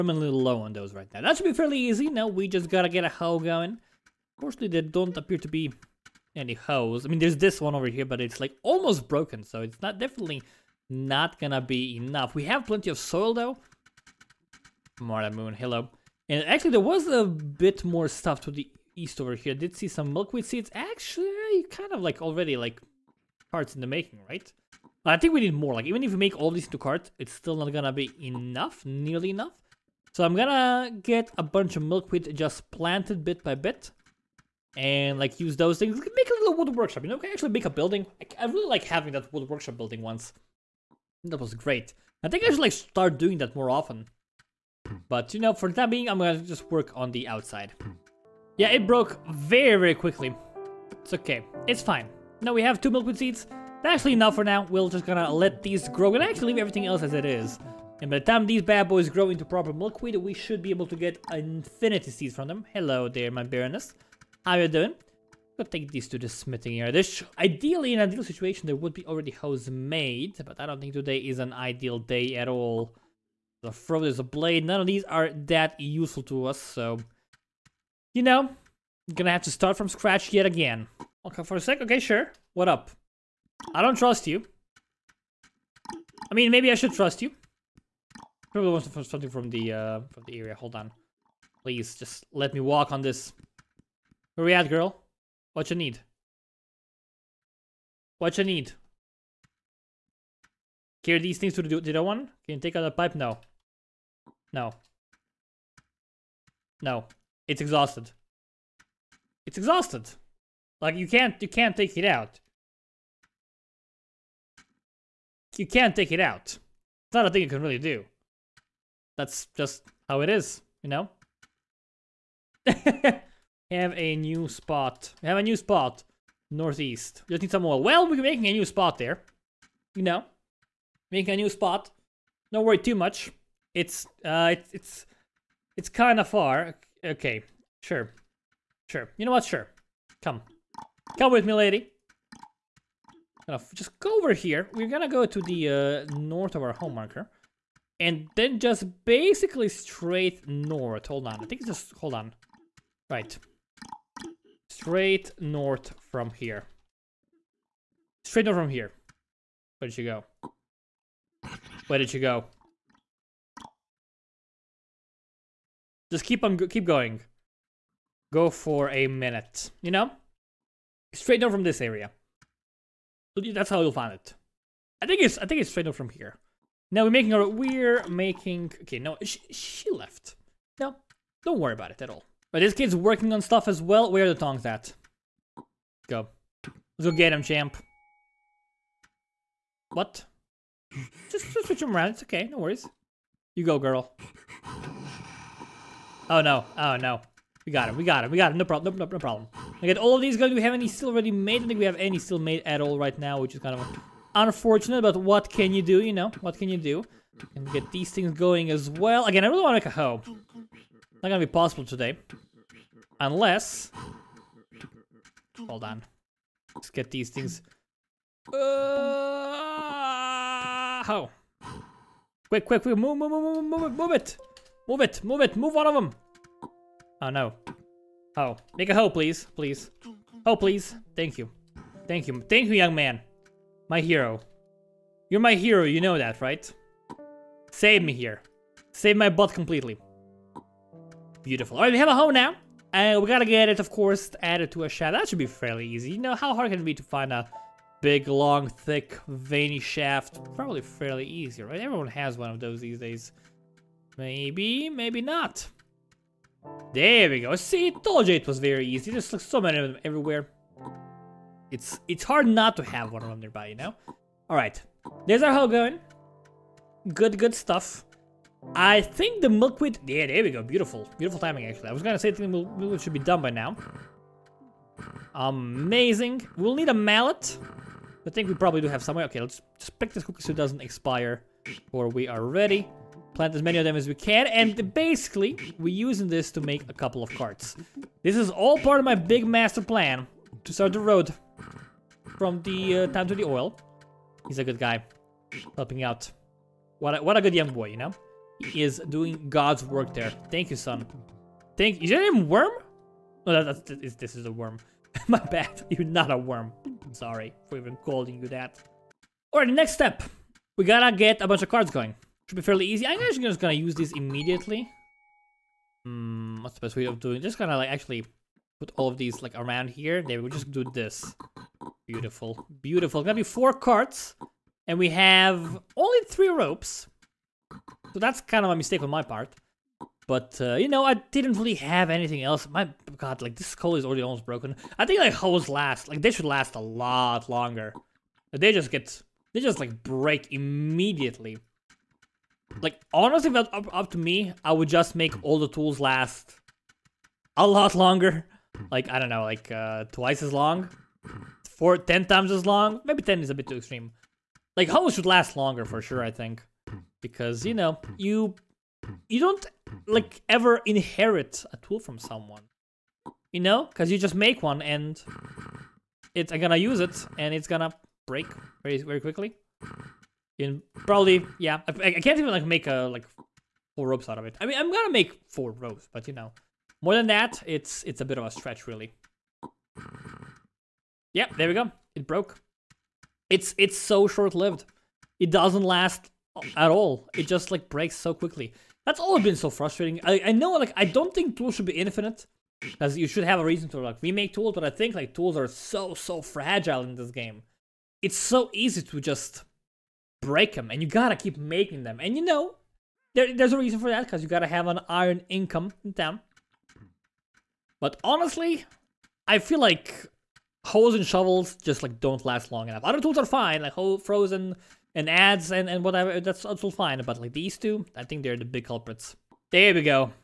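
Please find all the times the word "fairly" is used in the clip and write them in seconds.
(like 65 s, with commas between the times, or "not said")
1 s, 245 s, 250 s, 312 s.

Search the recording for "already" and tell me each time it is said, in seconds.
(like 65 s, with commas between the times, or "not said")
22 s, 69 s, 201 s, 334 s.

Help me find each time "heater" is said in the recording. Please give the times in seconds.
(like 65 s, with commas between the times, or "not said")
not said.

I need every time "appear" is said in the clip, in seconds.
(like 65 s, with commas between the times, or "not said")
5 s.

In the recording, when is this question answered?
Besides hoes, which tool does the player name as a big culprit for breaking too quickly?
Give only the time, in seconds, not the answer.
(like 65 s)
411 s.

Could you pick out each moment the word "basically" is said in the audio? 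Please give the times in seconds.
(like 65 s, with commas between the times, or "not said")
149 s, 284 s.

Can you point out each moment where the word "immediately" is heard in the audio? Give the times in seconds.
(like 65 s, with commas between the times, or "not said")
314 s, 340 s.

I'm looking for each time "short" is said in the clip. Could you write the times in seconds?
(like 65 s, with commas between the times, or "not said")
384 s.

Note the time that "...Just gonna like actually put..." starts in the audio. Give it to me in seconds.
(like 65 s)
317 s.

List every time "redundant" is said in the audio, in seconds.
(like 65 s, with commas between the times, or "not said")
not said.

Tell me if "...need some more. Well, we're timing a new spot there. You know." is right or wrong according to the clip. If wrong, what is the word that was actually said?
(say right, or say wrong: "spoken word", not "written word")
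wrong: "making", not "timing".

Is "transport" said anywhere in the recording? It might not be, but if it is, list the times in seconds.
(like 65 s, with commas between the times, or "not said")
not said.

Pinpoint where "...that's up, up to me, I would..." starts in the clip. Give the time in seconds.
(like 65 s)
343 s.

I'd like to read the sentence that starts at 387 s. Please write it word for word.
It just like breaks so quickly.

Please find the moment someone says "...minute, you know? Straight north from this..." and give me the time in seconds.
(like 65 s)
169 s.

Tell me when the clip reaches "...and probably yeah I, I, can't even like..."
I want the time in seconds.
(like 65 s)
370 s.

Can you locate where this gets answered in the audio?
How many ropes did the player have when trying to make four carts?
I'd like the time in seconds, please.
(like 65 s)
326 s.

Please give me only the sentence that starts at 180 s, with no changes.
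No, don't worry about it at all.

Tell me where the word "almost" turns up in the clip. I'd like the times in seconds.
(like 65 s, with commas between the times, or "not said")
8 s, 334 s.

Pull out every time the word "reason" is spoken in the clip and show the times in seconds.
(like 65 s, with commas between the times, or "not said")
393 s, 403 s.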